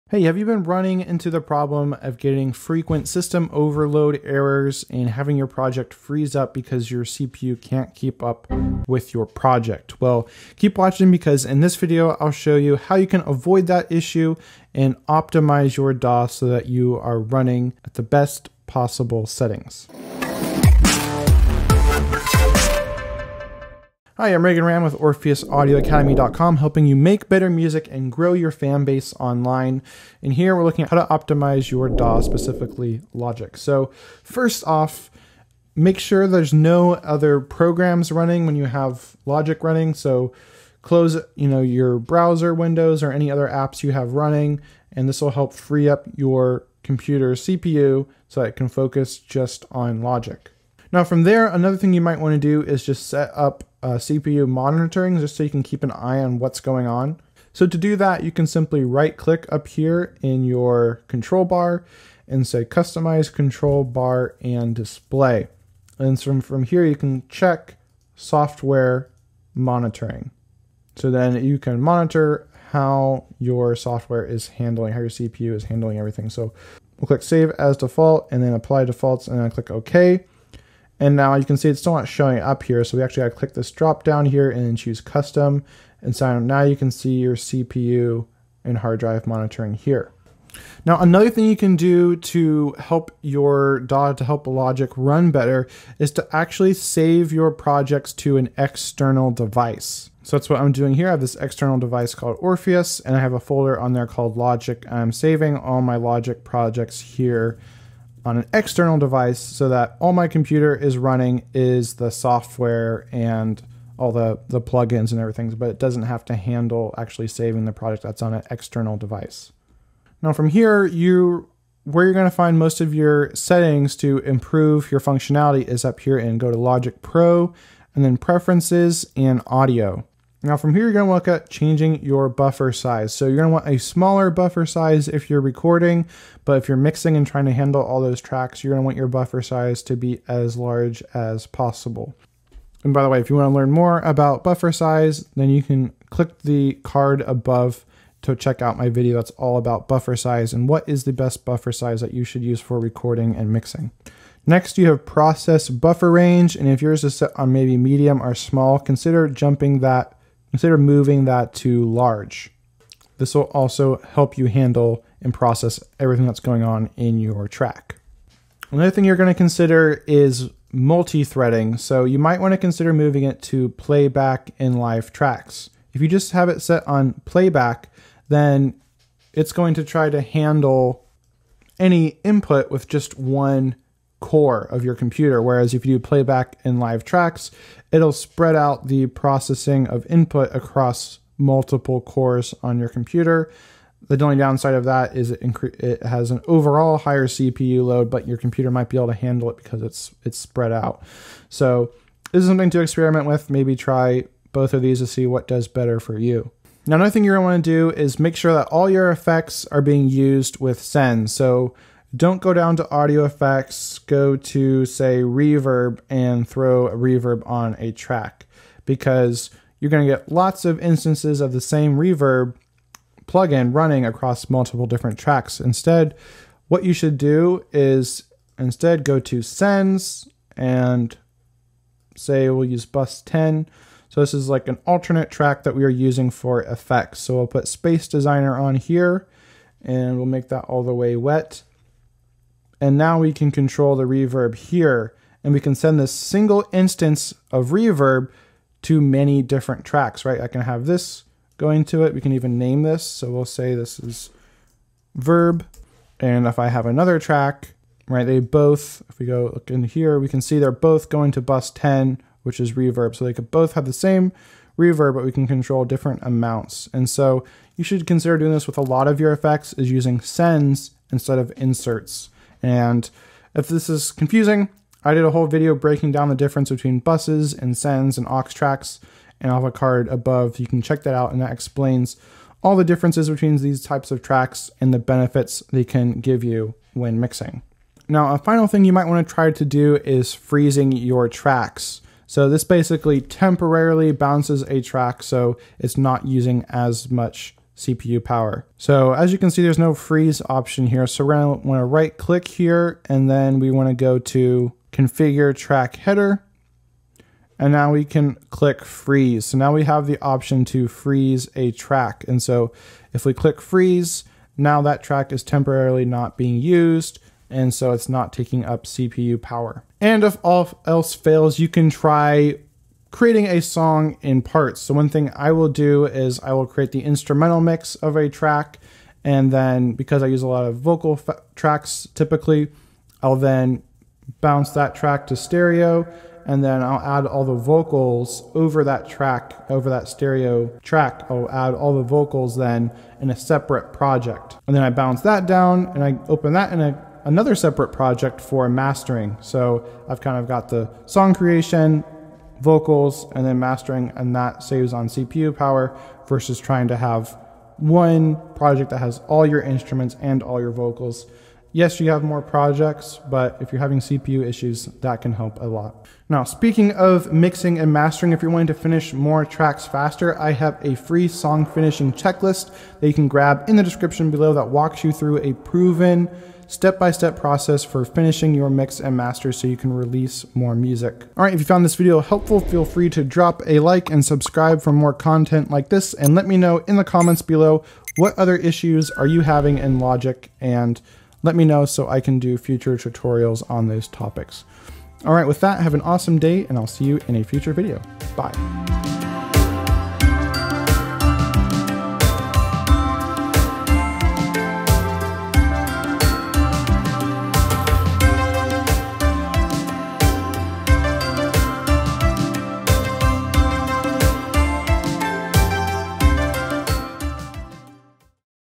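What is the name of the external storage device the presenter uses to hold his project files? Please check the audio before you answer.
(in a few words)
Orpheus.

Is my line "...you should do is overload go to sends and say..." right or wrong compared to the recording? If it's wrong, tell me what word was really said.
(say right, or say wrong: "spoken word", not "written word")
wrong: "instead", not "overload".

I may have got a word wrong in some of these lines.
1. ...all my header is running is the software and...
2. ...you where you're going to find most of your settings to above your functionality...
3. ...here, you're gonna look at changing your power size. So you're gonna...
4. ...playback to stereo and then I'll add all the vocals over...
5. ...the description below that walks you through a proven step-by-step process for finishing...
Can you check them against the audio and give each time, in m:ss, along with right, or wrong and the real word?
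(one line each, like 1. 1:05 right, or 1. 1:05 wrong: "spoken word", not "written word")
1. 1:49 wrong: "computer", not "header"
2. 2:00 wrong: "improve", not "above"
3. 2:10 wrong: "buffer", not "power"
4. 5:34 wrong: "track", not "playback"
5. 6:13 right.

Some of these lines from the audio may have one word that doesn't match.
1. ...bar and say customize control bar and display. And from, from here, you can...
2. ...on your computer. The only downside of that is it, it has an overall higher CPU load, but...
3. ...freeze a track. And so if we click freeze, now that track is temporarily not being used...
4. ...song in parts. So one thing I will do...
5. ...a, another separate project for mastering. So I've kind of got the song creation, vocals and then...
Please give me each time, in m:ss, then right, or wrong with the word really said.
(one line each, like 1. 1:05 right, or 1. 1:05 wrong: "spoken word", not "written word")
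1. 1:01 right
2. 3:12 right
3. 5:10 right
4. 5:23 right
5. 5:46 right.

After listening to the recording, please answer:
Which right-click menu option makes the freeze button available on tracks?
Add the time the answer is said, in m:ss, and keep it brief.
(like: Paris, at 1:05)
configure track header, at 5:04.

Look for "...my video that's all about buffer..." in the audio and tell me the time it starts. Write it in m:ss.
2:28.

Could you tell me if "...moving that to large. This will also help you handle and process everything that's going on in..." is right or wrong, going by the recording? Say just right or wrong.
right.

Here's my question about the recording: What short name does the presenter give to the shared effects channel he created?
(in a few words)
verb.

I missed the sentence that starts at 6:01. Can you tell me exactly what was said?
Yes, you have more projects, but if you're having CPU issues, that can help a lot.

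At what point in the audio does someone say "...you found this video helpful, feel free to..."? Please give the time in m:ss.
6:21.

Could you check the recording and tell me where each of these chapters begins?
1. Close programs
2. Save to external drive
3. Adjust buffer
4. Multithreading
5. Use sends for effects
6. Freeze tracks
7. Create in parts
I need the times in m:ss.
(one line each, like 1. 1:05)
1. 0:34
2. 1:30
3. 1:59
4. 2:47
5. 3:36
6. 4:47
7. 5:19.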